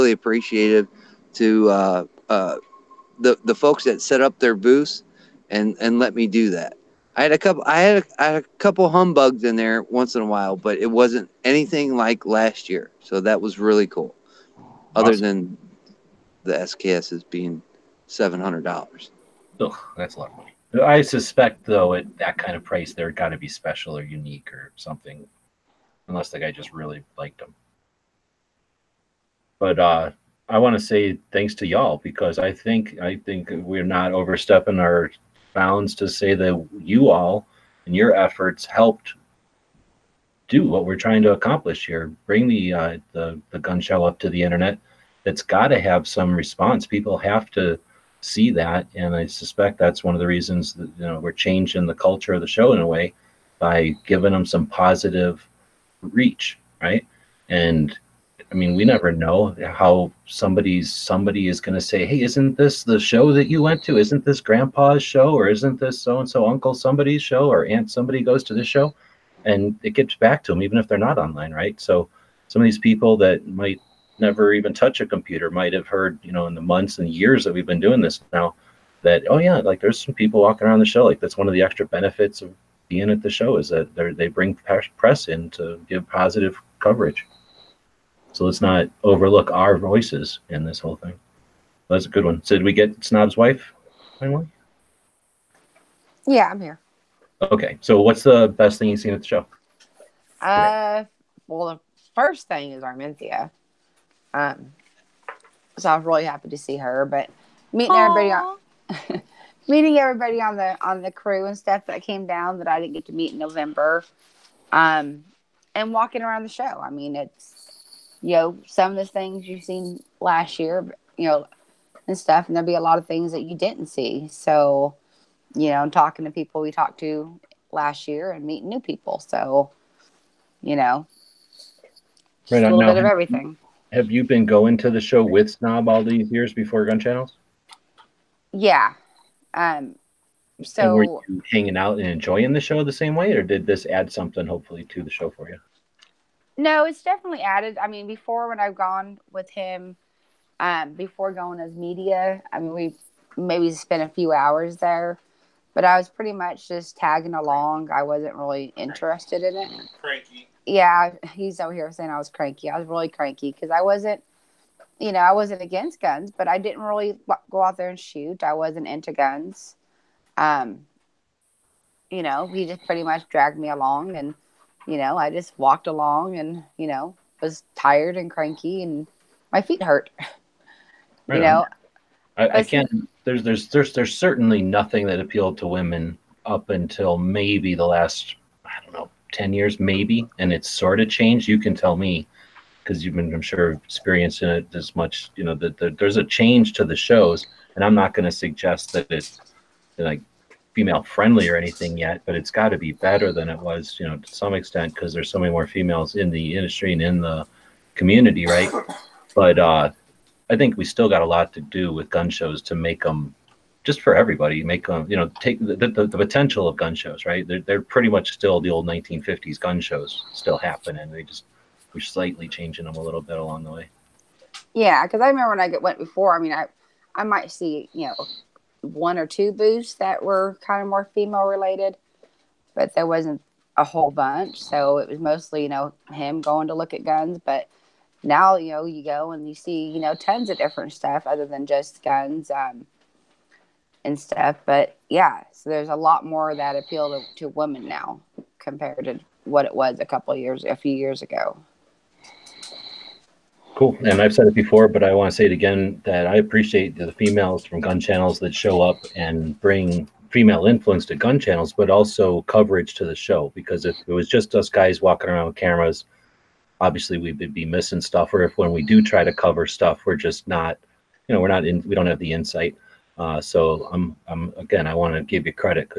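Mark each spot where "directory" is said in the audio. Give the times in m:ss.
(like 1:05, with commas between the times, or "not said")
not said.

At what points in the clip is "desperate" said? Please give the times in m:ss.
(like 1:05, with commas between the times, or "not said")
not said.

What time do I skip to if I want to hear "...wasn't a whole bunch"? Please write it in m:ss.
3:53.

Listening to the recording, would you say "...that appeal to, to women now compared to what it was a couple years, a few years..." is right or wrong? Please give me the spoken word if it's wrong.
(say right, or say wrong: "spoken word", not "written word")
right.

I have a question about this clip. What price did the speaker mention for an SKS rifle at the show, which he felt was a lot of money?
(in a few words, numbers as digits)
$700.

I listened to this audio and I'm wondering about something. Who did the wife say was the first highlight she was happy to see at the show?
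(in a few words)
Armenthea.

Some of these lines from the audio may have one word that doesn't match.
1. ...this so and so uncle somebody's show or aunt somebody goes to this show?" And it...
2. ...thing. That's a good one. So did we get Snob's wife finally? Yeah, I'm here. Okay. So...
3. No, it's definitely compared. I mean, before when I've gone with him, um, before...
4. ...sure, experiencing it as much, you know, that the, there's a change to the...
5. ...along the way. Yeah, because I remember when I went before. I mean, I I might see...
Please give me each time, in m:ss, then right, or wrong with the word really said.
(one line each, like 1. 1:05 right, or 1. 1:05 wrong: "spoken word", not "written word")
1. 1:05 right
2. 1:30 right
3. 2:26 wrong: "added", not "compared"
4. 3:13 right
5. 3:43 right.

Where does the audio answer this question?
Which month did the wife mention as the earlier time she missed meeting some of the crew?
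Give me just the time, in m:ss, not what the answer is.
1:53.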